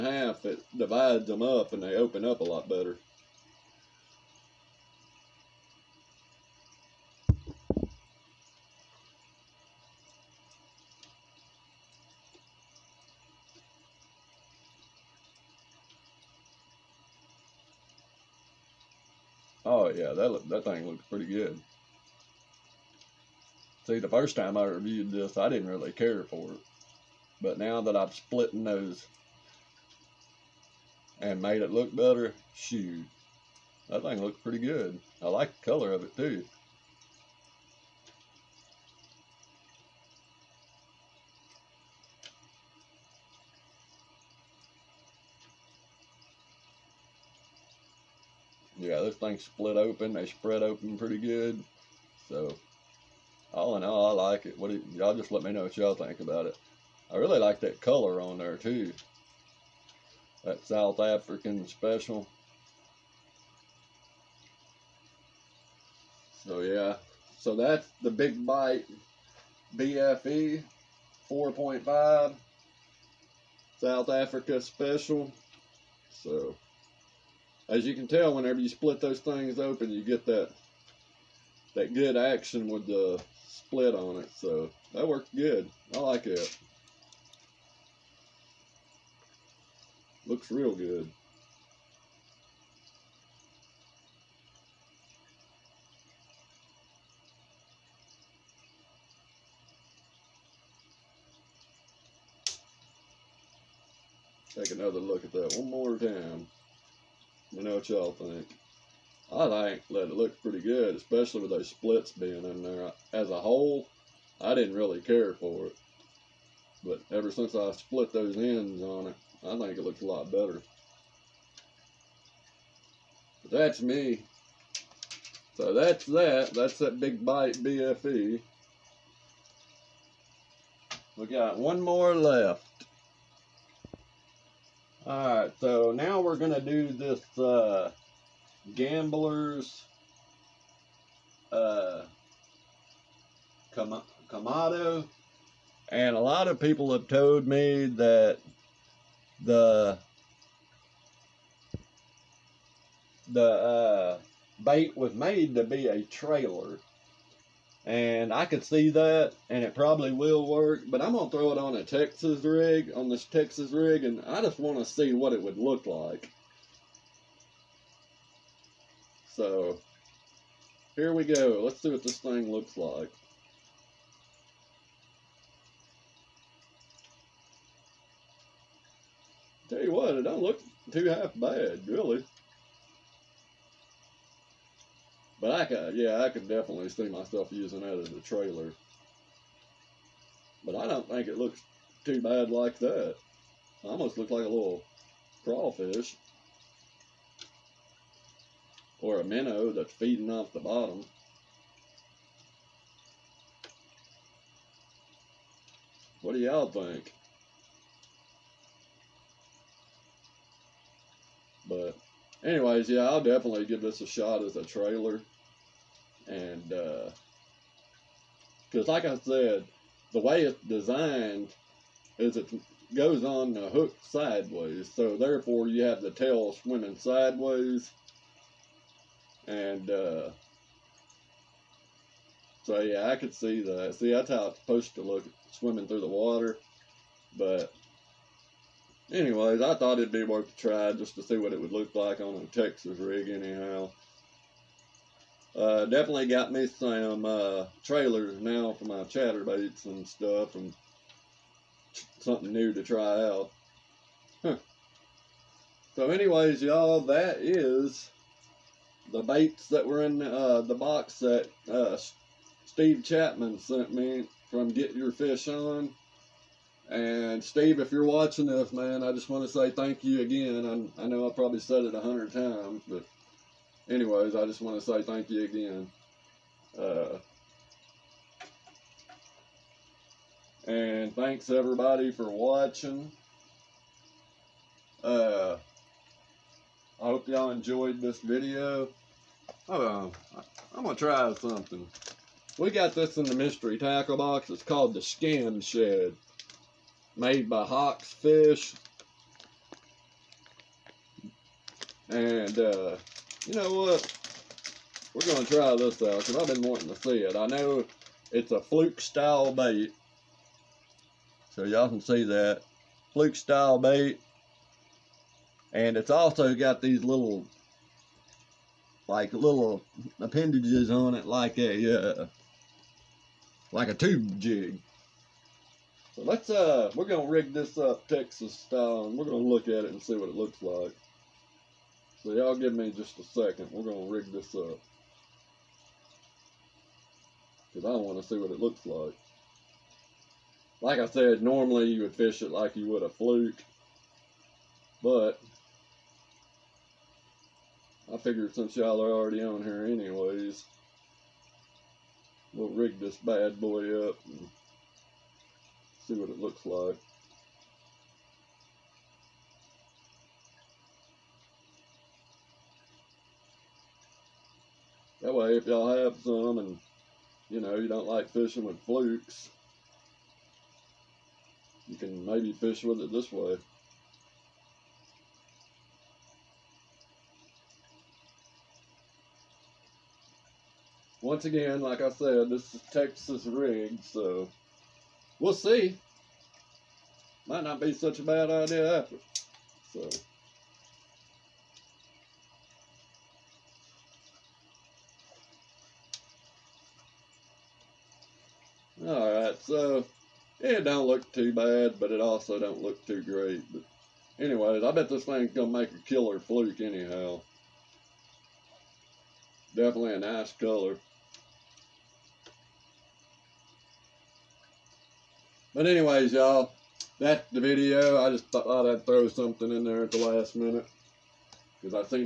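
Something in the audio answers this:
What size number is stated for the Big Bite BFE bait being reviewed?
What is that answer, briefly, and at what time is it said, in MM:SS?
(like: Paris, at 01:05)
4.5, at 01:11.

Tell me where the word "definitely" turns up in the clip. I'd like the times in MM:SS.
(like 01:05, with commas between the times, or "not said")
03:06, 03:33, 04:05, 06:49.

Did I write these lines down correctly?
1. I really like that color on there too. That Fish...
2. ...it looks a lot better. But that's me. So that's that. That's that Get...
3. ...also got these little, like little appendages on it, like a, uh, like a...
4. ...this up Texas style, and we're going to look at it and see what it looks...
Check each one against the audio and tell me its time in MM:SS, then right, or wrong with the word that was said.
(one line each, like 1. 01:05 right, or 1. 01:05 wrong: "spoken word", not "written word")
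1. 00:57 wrong: "South", not "Fish"
2. 01:59 wrong: "Big", not "Get"
3. 05:16 right
4. 05:27 right.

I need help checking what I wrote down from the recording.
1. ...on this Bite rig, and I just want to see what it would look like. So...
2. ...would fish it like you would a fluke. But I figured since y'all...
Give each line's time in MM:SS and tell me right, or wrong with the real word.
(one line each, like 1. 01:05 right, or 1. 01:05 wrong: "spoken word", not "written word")
1. 02:42 wrong: "Texas", not "Bite"
2. 05:42 right.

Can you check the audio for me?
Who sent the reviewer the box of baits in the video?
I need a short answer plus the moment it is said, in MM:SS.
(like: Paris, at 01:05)
Steve Chapman, at 04:22.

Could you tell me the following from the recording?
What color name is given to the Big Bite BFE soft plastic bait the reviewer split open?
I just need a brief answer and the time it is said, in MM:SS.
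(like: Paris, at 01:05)
South Africa special, at 01:13.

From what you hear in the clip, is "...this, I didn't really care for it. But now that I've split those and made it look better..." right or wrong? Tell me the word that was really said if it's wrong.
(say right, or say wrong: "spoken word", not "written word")
right.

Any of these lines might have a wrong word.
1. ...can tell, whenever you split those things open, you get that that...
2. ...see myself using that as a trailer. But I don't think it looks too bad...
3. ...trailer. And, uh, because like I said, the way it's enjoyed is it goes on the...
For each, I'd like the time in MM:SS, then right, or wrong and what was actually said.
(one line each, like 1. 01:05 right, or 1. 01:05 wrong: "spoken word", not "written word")
1. 01:17 right
2. 03:06 right
3. 03:34 wrong: "designed", not "enjoyed".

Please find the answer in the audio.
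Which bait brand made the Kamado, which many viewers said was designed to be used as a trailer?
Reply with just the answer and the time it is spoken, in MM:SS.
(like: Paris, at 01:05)
Gamblers, at 02:18.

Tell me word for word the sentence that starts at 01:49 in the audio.
I think that it looks pretty good, especially with those splits being in there.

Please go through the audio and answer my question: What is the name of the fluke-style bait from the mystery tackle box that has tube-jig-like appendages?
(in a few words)
Skin Shed.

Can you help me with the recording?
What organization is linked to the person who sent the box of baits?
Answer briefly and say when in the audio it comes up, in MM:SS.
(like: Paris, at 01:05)
Get Your Fish On, at 04:24.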